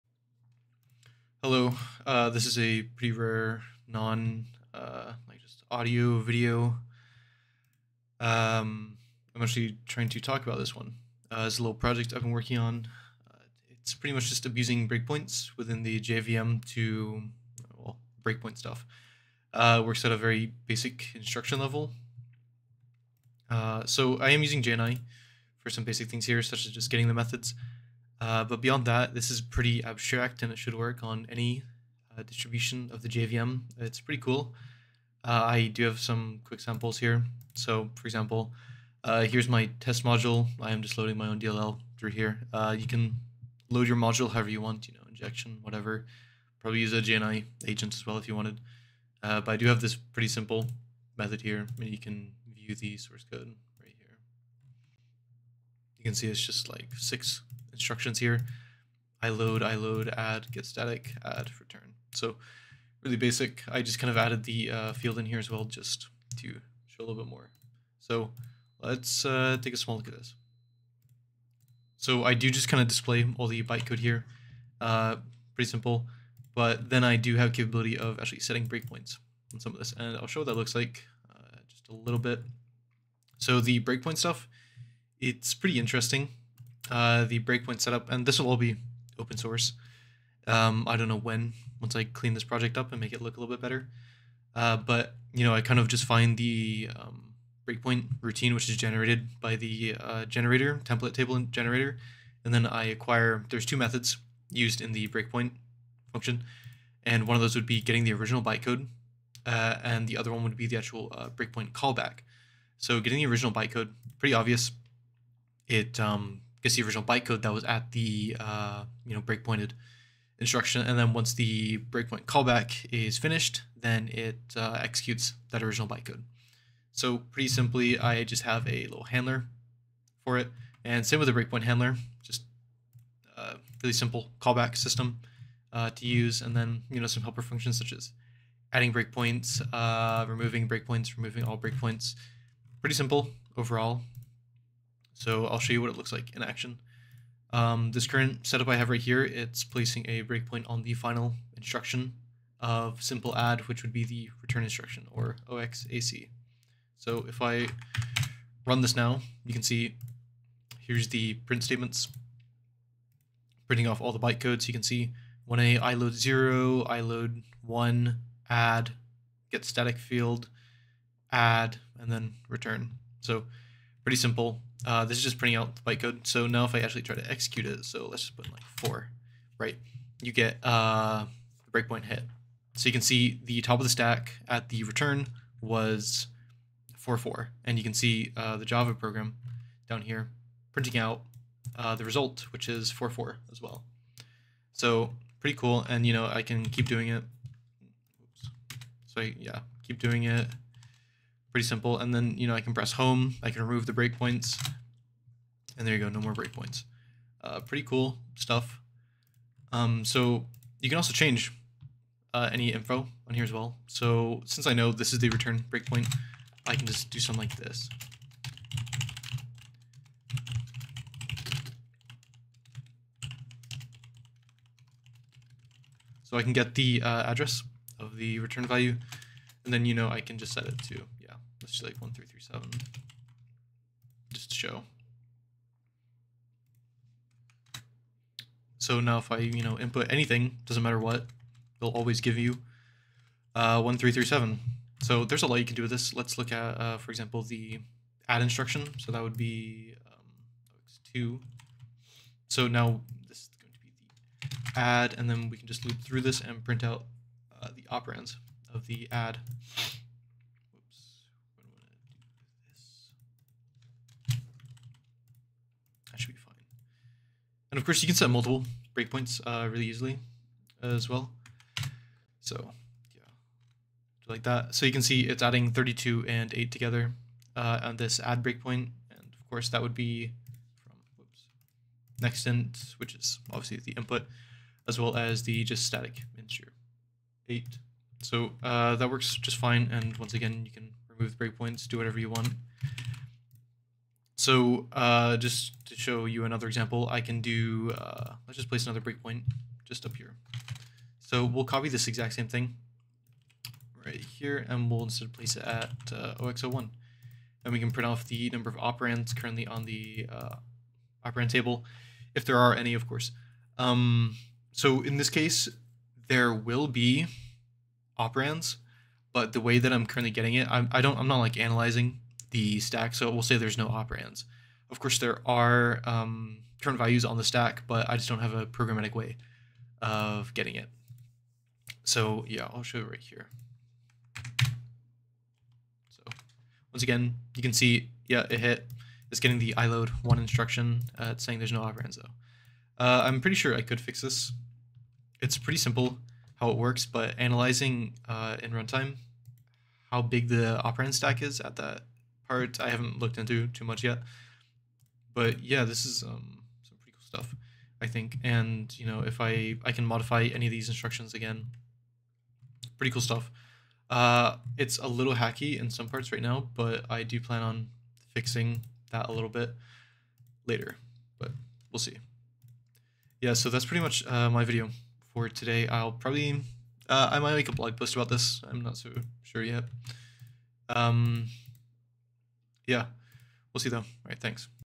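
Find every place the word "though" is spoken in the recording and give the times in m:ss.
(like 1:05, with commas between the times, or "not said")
5:42, 6:23.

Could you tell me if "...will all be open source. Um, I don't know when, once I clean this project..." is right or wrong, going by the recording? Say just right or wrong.
right.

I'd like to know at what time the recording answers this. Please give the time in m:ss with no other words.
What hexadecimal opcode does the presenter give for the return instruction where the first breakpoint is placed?
2:35.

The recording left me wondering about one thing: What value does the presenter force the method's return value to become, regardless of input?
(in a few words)
1337.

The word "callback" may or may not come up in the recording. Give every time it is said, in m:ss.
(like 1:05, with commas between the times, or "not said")
1:51, 2:02, 2:14.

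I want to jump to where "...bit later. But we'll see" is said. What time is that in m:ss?
6:09.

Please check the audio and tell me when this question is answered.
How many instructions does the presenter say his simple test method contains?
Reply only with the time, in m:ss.
0:56.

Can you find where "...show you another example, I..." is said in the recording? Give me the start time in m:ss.
4:55.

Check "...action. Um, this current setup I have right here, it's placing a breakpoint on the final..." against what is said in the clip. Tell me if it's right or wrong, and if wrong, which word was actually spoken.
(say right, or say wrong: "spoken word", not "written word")
right.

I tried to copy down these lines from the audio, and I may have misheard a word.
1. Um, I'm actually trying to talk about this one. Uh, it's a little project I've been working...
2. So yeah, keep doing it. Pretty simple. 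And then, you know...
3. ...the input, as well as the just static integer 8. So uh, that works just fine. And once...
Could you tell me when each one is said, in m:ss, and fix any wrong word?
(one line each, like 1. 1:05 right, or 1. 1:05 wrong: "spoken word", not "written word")
1. 0:08 right
2. 3:19 right
3. 4:43 right.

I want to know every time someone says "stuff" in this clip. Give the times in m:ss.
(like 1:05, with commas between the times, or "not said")
0:18, 1:24, 3:28, 5:57, 6:03.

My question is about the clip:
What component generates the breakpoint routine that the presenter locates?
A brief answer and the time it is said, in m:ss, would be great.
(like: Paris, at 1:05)
template table generator, at 1:40.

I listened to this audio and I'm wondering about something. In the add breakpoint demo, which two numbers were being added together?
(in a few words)
32 and 8.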